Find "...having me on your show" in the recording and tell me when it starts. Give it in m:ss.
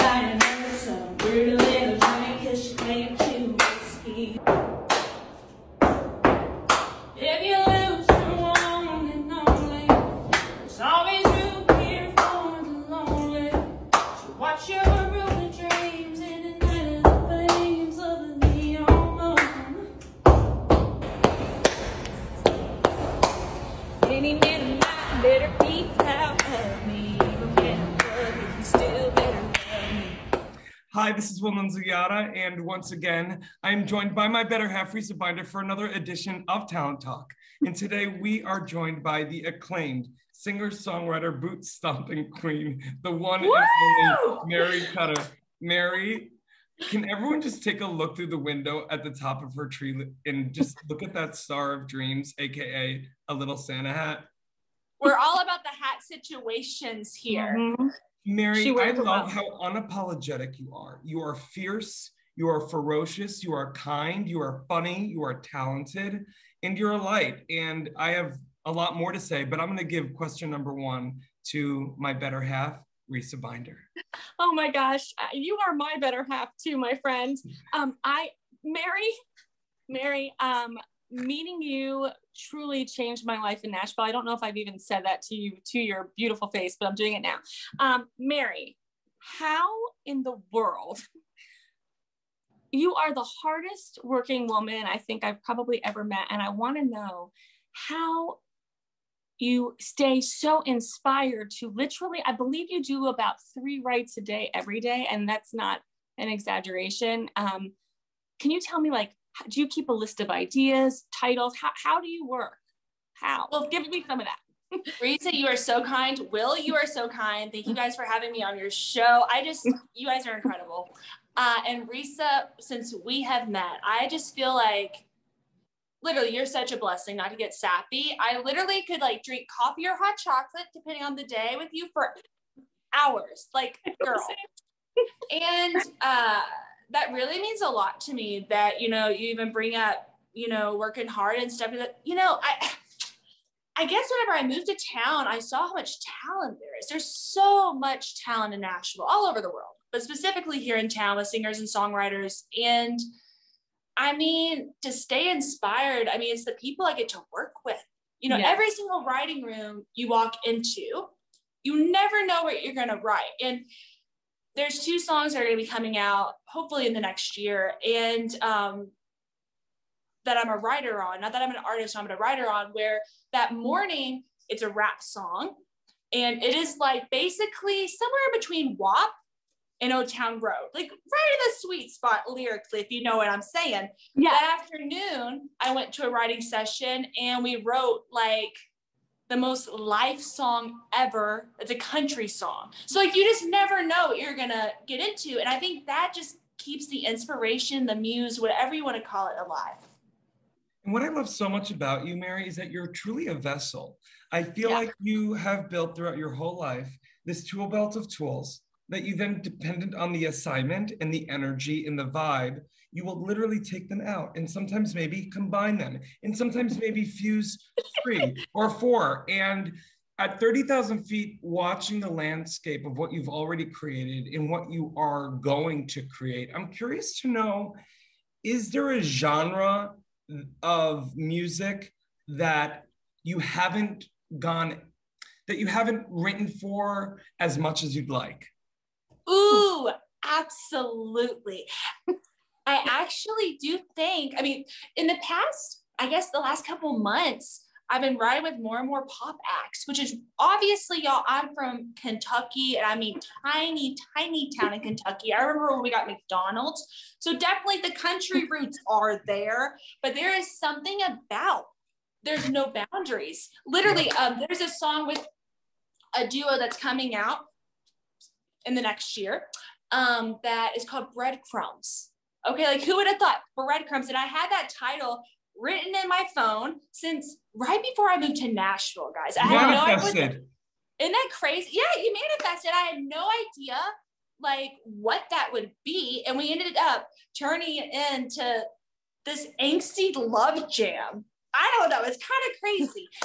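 1:58.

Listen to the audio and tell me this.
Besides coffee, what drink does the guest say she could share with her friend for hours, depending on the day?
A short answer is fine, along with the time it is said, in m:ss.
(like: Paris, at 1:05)
Hot chocolate, at 2:09.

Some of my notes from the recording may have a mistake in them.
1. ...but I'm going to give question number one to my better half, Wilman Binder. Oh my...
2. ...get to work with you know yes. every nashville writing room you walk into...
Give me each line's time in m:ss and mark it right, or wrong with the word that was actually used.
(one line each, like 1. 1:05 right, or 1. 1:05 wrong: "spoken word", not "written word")
1. 1:09 wrong: "Risa", not "Wilman"
2. 2:36 wrong: "single", not "nashville".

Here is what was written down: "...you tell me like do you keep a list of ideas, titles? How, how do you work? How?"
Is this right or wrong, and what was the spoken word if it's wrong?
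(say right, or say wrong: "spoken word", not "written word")
right.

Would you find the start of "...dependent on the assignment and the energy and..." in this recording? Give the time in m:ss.
3:29.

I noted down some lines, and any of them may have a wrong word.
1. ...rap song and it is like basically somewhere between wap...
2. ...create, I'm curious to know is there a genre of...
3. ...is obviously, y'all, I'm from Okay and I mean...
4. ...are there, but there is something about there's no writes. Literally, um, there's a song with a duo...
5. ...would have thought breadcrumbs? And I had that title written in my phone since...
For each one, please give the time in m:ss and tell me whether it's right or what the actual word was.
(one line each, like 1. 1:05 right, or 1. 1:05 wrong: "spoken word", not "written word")
1. 2:54 right
2. 3:46 right
3. 4:09 wrong: "Kentucky", not "Okay"
4. 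4:18 wrong: "boundaries", not "writes"
5. 4:32 right.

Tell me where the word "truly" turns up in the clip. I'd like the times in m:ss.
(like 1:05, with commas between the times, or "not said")
1:22, 3:22.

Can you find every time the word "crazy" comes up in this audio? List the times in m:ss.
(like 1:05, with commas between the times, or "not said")
4:41, 4:52.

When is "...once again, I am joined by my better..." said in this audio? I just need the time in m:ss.
0:32.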